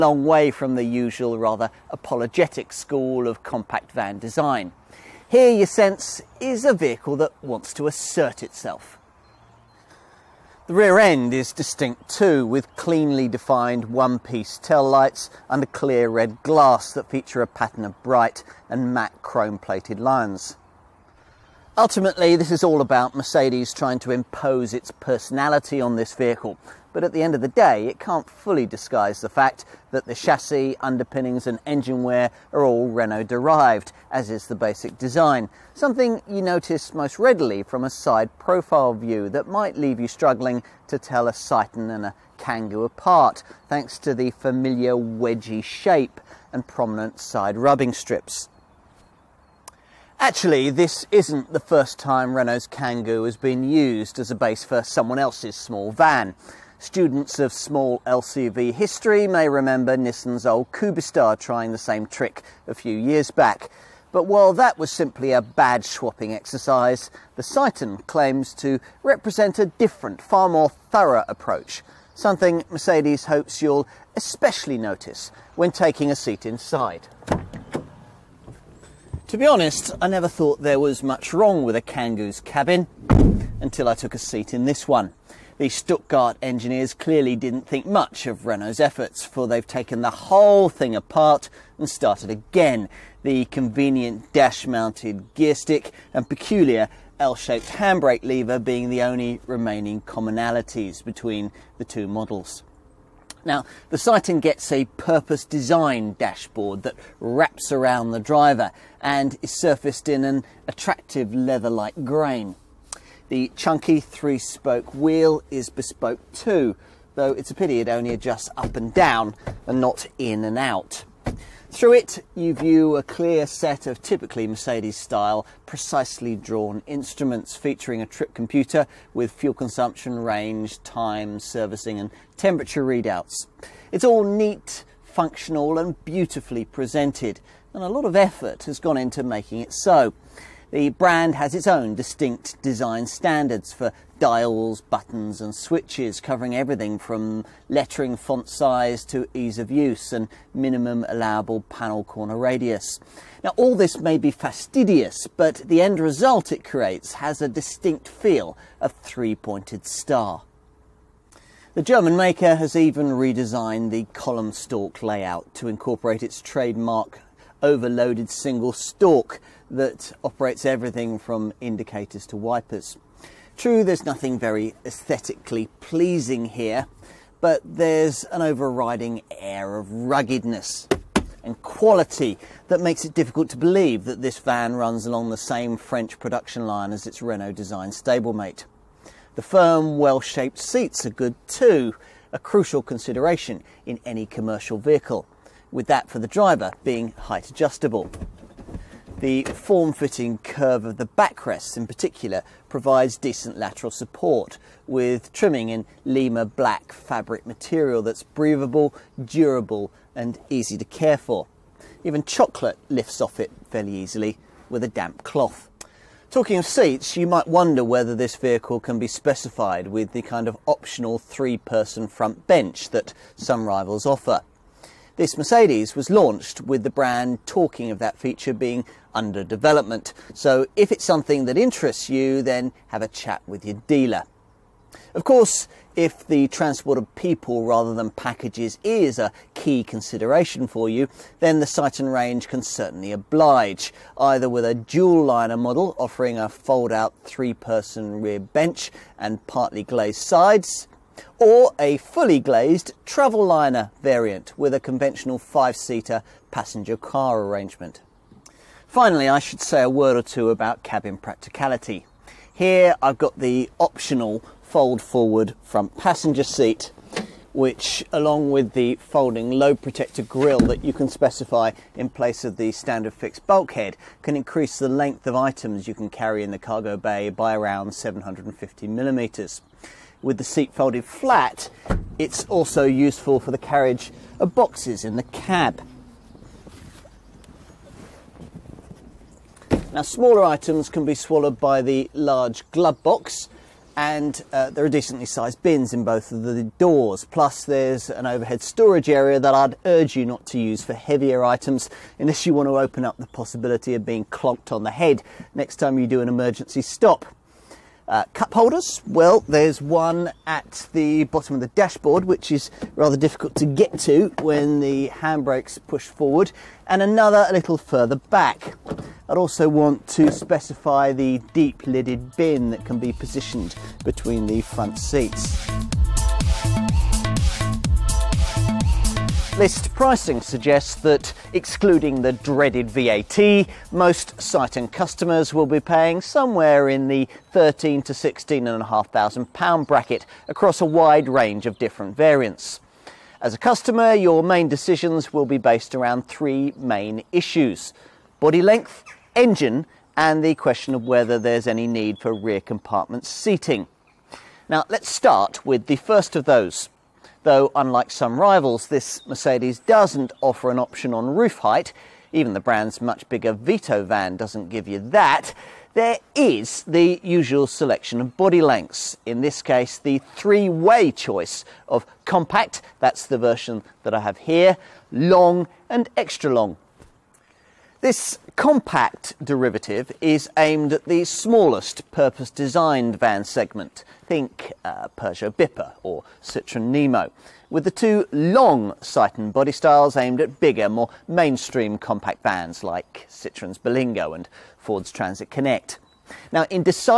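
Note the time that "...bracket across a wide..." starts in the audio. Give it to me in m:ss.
5:39.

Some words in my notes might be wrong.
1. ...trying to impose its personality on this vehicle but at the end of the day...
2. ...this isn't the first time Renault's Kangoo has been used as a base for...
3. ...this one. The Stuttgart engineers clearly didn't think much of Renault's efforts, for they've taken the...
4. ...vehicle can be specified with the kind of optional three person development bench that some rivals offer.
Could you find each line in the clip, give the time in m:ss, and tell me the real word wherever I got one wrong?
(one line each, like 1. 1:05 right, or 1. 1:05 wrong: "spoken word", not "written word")
1. 0:23 right
2. 0:50 right
3. 1:24 right
4. 3:38 wrong: "front", not "development".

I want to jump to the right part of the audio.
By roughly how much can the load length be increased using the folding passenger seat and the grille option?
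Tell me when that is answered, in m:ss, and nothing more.
4:37.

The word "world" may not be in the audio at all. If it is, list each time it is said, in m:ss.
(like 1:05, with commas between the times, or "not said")
not said.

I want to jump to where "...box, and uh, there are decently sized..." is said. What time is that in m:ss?
4:53.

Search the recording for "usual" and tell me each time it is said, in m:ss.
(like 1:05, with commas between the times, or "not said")
0:00, 6:07.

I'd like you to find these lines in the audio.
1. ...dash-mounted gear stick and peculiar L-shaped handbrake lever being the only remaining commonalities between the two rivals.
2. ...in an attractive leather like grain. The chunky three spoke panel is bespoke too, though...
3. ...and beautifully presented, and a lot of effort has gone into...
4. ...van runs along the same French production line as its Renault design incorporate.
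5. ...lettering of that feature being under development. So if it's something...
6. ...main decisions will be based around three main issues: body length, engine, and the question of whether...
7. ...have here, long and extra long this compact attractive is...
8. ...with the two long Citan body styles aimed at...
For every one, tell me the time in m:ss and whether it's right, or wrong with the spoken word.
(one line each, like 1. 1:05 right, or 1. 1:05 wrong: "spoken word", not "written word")
1. 1:34 wrong: "models", not "rivals"
2. 1:50 wrong: "wheel", not "panel"
3. 2:15 right
4. 3:04 wrong: "stablemate", not "incorporate"
5. 3:47 wrong: "talking", not "lettering"
6. 5:44 right
7. 6:14 wrong: "derivative", not "attractive"
8. 6:27 right.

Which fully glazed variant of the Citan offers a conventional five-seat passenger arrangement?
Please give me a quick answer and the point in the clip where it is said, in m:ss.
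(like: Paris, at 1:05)
travel liner, at 4:13.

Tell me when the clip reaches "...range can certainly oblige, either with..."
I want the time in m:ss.
4:02.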